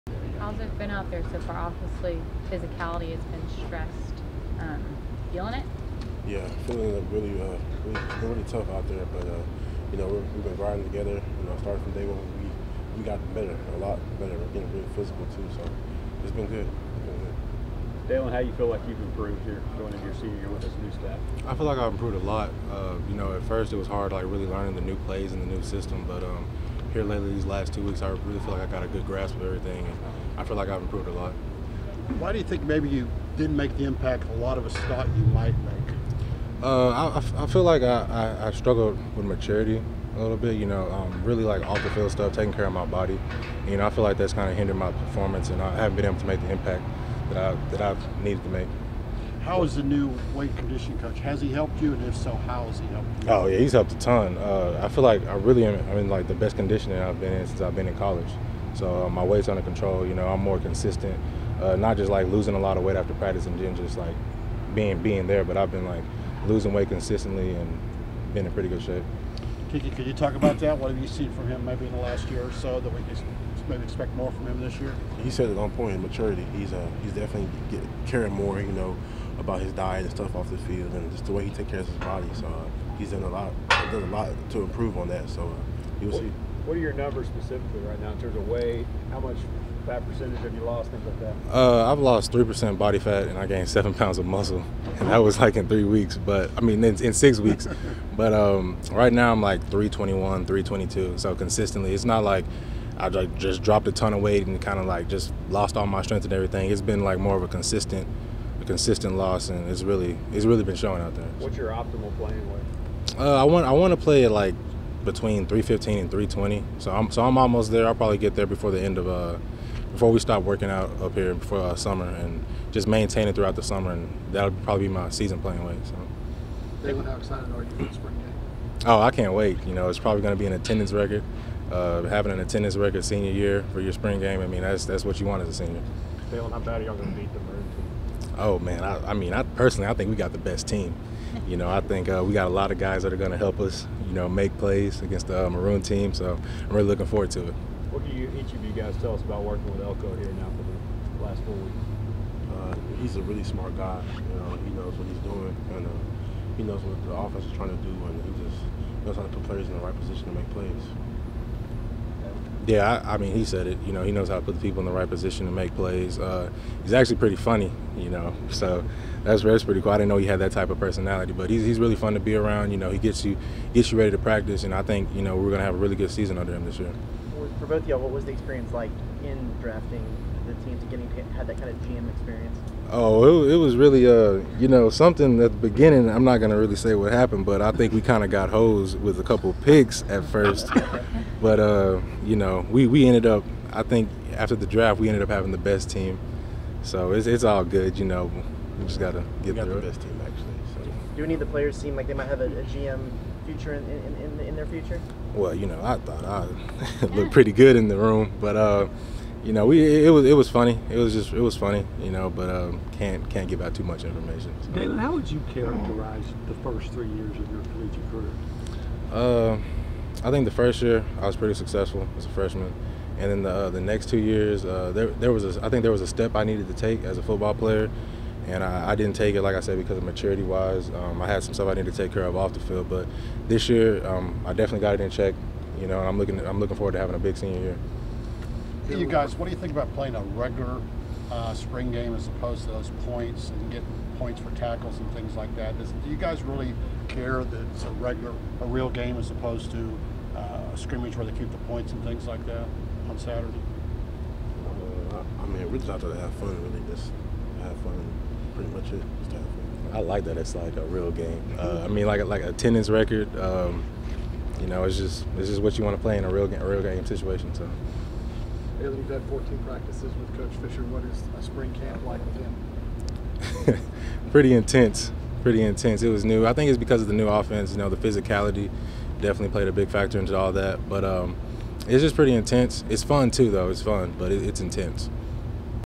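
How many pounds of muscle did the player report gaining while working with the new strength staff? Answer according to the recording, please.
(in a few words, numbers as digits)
7 pounds.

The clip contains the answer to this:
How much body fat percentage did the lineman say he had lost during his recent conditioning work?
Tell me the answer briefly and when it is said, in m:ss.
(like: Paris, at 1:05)
3 percent, at 1:32.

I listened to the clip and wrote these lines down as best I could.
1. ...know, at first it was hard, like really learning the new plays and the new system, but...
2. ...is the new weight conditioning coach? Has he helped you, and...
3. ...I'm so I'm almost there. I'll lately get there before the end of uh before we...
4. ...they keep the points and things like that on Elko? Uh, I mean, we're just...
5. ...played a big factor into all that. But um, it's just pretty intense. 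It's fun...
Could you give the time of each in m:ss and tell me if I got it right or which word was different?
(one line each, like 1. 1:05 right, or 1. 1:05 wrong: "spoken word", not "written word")
1. 0:23 right
2. 0:49 right
3. 1:56 wrong: "probably", not "lately"
4. 4:11 wrong: "Saturday", not "Elko"
5. 4:39 right.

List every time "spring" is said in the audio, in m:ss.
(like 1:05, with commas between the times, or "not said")
2:07, 2:13, 4:01, 4:31.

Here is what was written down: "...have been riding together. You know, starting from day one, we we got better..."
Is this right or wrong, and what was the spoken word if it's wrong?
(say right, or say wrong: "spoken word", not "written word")
right.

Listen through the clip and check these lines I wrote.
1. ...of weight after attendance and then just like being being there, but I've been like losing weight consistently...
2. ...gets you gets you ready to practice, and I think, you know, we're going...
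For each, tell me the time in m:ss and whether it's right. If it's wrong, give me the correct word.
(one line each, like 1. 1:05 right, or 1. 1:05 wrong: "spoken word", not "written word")
1. 1:02 wrong: "practice", not "attendance"
2. 2:52 right.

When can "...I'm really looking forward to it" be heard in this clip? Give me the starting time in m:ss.
2:26.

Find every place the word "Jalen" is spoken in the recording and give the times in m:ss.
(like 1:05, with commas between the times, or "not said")
2:06, 2:16.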